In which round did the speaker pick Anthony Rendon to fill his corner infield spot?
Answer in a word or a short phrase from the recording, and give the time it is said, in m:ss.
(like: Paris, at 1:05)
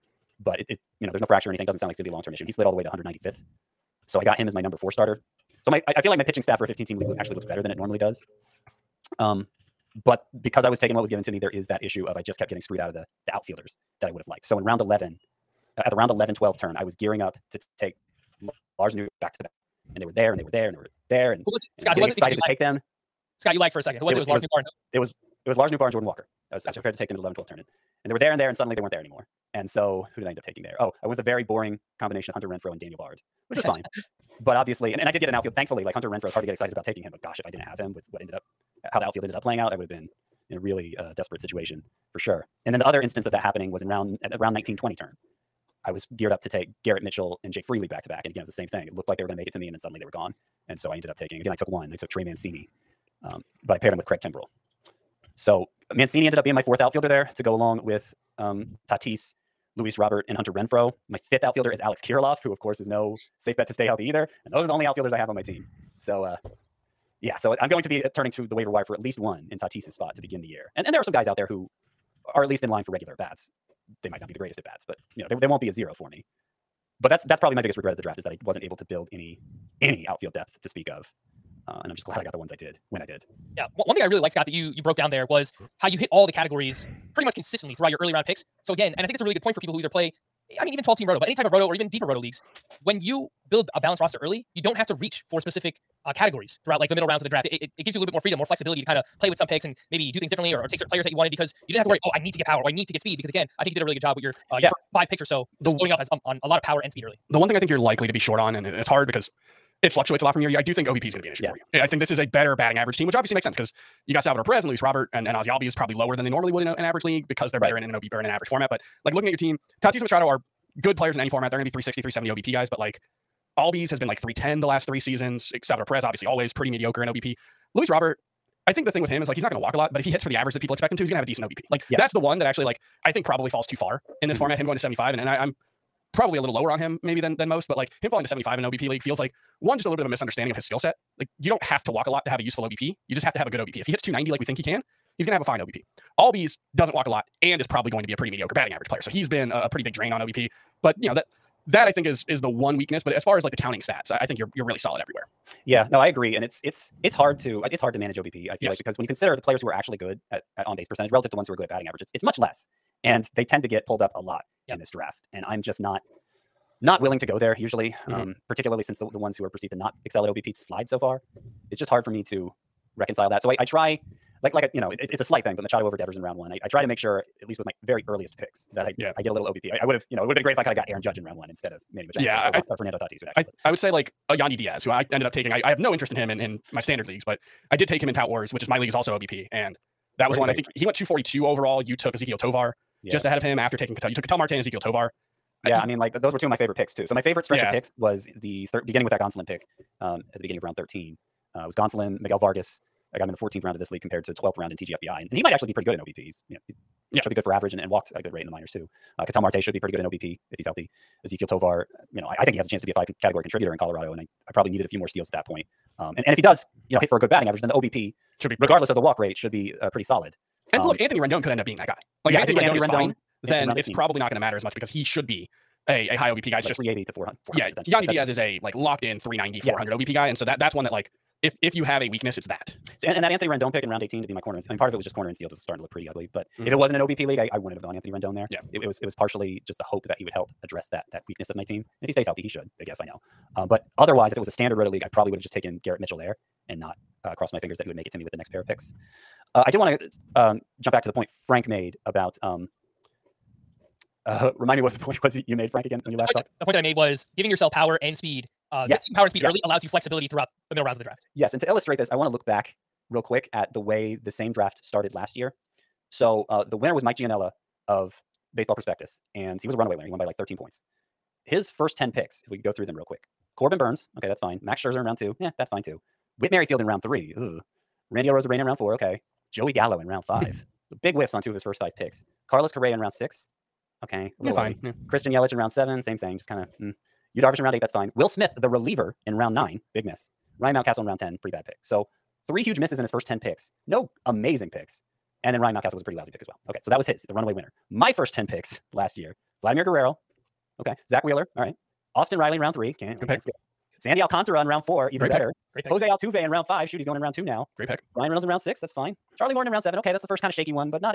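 round 18, at 3:53.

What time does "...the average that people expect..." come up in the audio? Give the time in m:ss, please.
2:10.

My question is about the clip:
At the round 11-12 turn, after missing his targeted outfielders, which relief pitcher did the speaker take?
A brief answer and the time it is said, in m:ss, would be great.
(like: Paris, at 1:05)
Daniel Bard, at 0:32.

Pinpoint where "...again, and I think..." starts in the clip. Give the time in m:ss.
1:28.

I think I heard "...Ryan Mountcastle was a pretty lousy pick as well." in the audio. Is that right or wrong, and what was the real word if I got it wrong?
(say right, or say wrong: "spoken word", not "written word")
right.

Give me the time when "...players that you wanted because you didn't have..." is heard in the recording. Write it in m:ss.
1:40.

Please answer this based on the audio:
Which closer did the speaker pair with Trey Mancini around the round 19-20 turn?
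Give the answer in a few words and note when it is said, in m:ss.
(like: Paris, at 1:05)
Craig Kimbrel, at 0:54.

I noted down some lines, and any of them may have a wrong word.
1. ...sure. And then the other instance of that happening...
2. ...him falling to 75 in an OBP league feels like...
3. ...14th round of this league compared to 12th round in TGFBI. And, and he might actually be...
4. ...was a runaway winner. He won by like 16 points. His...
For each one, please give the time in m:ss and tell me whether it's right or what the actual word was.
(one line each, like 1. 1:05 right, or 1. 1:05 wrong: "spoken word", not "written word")
1. 0:42 right
2. 2:18 right
3. 3:23 right
4. 4:29 wrong: "13", not "16".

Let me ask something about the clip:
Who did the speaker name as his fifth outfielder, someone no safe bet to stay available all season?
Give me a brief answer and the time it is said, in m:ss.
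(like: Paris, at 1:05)
Alex Kirilloff, at 1:01.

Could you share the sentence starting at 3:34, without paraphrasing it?
And I, I probably needed a few more steals at that point.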